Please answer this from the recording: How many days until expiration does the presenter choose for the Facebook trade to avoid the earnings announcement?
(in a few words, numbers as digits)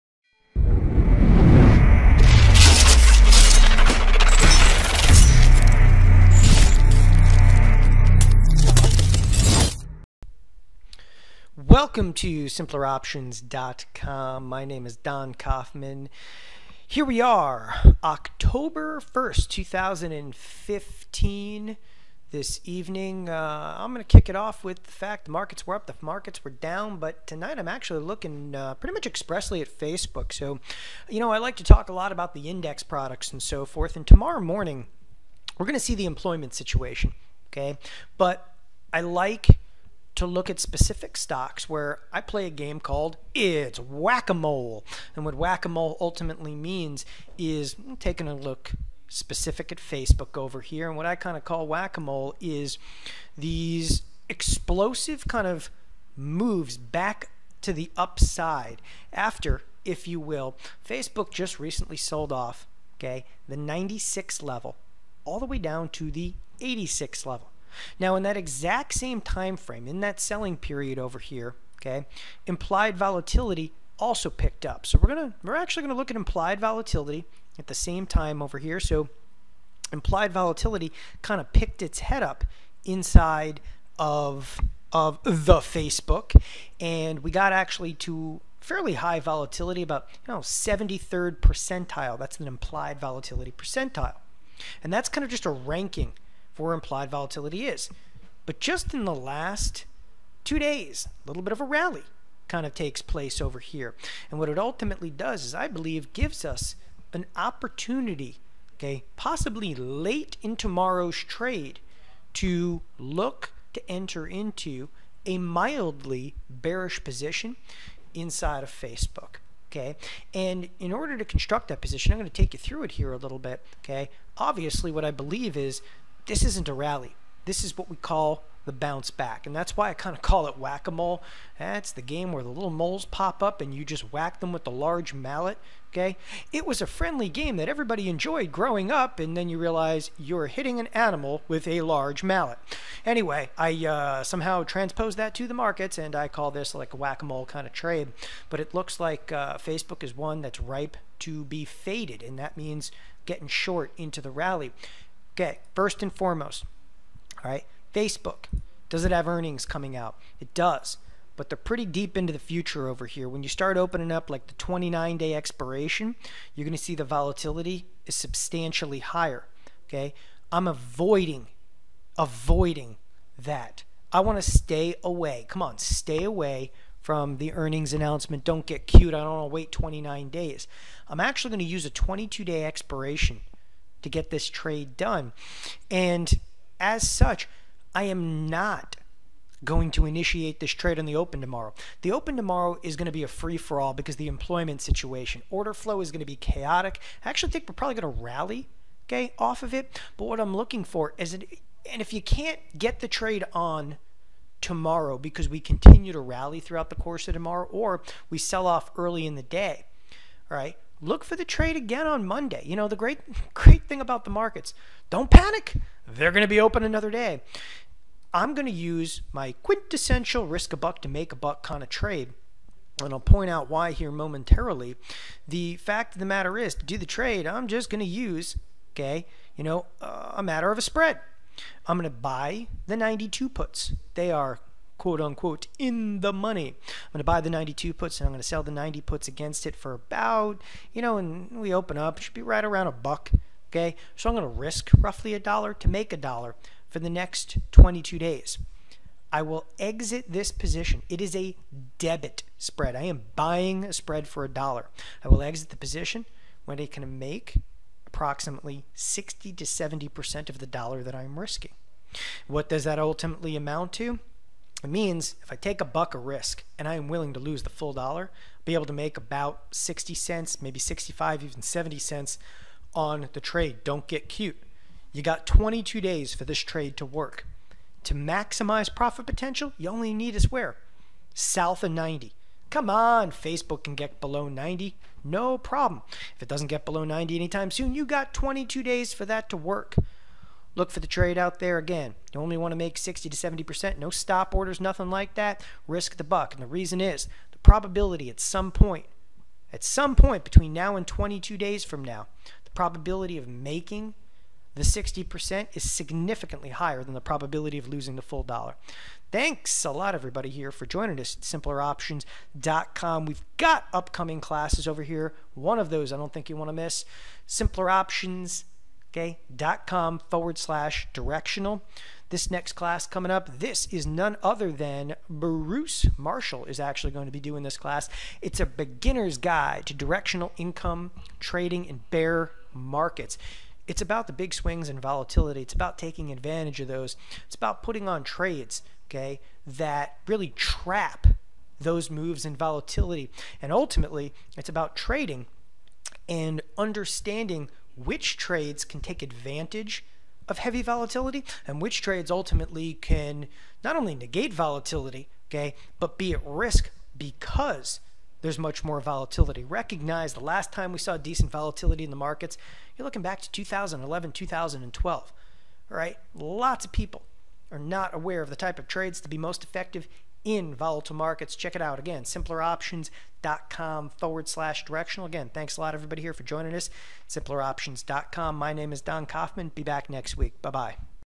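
22.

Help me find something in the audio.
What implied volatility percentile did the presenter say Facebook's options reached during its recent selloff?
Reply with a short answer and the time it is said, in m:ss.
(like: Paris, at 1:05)
73rd percentile, at 1:30.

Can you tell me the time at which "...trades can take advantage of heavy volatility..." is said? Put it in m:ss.
5:48.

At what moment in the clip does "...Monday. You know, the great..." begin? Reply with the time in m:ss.
3:32.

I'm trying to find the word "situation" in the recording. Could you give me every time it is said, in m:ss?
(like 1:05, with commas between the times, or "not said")
0:36, 3:14.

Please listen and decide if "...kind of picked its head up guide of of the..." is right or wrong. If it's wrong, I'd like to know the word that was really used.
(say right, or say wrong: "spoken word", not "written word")
wrong: "inside", not "guide".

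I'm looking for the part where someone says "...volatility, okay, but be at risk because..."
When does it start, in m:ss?
5:54.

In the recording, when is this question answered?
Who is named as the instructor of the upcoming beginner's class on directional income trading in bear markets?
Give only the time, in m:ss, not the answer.
5:25.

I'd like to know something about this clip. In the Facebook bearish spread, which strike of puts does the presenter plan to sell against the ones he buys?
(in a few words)
90.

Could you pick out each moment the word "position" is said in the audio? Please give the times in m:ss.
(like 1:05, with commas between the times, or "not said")
1:57, 2:01, 4:10, 4:15.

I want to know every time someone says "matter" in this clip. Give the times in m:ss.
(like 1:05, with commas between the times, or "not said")
3:46, 3:50.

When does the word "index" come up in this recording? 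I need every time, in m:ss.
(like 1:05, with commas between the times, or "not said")
0:32.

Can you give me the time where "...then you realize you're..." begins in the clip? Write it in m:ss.
2:19.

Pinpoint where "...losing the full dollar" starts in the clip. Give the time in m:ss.
5:07.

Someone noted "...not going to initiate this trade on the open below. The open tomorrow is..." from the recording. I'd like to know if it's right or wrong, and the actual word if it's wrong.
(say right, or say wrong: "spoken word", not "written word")
wrong: "tomorrow", not "below".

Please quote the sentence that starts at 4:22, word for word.
What does that ultimately amount to?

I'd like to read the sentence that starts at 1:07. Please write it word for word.
Now in that exact same time frame, in that selling period over here, okay, implied volatility also picked up.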